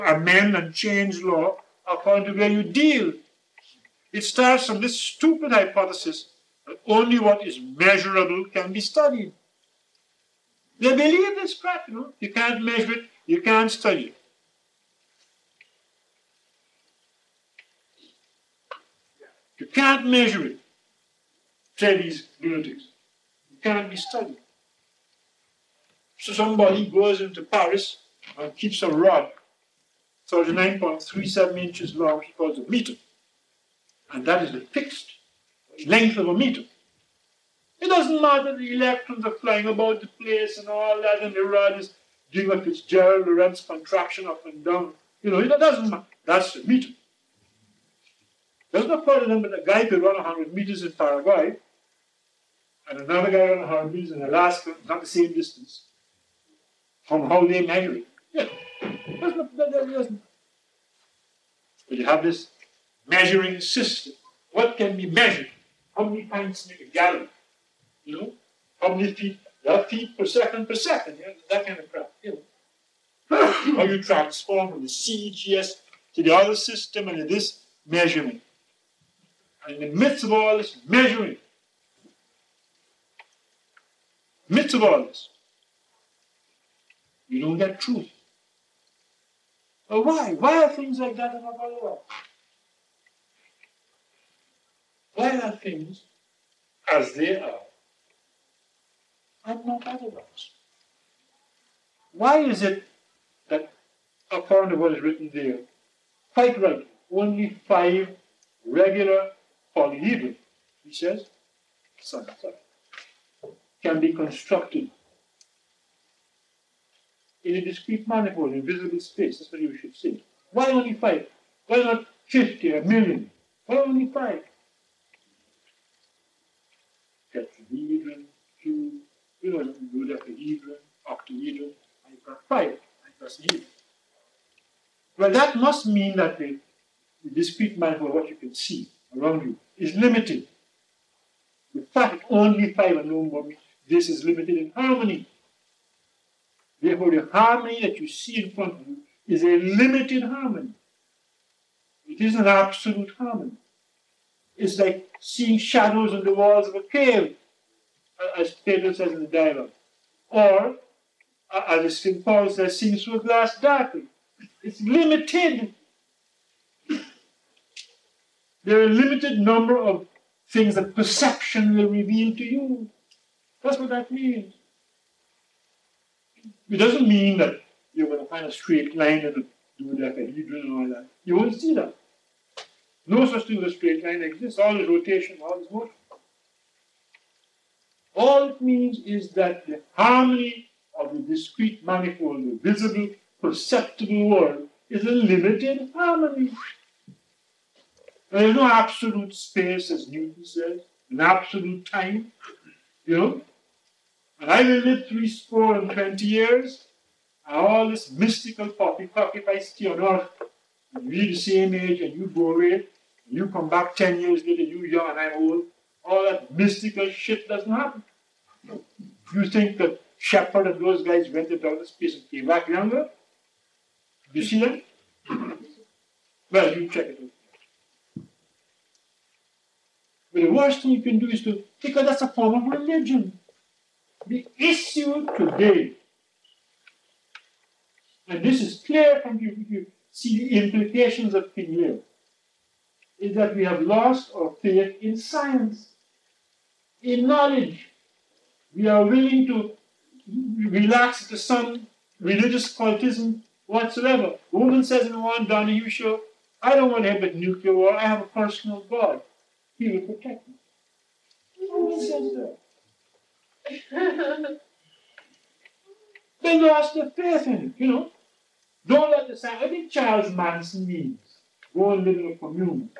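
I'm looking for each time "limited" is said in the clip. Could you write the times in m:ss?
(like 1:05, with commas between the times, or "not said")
2:19, 2:24, 2:29, 2:44, 2:48, 3:15.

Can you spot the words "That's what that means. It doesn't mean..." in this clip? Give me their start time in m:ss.
2:53.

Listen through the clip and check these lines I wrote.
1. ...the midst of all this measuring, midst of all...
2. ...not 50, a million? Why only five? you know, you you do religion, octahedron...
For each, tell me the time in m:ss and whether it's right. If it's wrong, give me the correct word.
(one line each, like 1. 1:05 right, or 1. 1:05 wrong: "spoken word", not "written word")
1. 1:19 right
2. 2:01 wrong: "dodecahedron", not "religion".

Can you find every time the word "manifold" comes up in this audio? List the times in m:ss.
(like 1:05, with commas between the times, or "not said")
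1:58, 2:17, 3:11.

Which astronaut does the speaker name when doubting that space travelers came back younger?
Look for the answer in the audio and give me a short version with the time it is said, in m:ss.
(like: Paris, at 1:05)
Shepard, at 3:40.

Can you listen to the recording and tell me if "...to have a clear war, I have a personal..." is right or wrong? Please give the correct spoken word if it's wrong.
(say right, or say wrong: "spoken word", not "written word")
wrong: "nuclear", not "clear".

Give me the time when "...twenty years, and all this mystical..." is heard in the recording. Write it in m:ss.
3:25.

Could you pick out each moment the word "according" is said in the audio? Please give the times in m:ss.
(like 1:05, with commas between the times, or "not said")
0:01, 1:44.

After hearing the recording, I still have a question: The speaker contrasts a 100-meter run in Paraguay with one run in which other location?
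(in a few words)
Alaska.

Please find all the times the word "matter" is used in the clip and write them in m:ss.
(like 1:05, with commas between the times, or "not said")
0:38, 0:45.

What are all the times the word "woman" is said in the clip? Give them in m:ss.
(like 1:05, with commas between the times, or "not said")
4:14, 4:21.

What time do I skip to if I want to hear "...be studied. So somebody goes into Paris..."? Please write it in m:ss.
0:23.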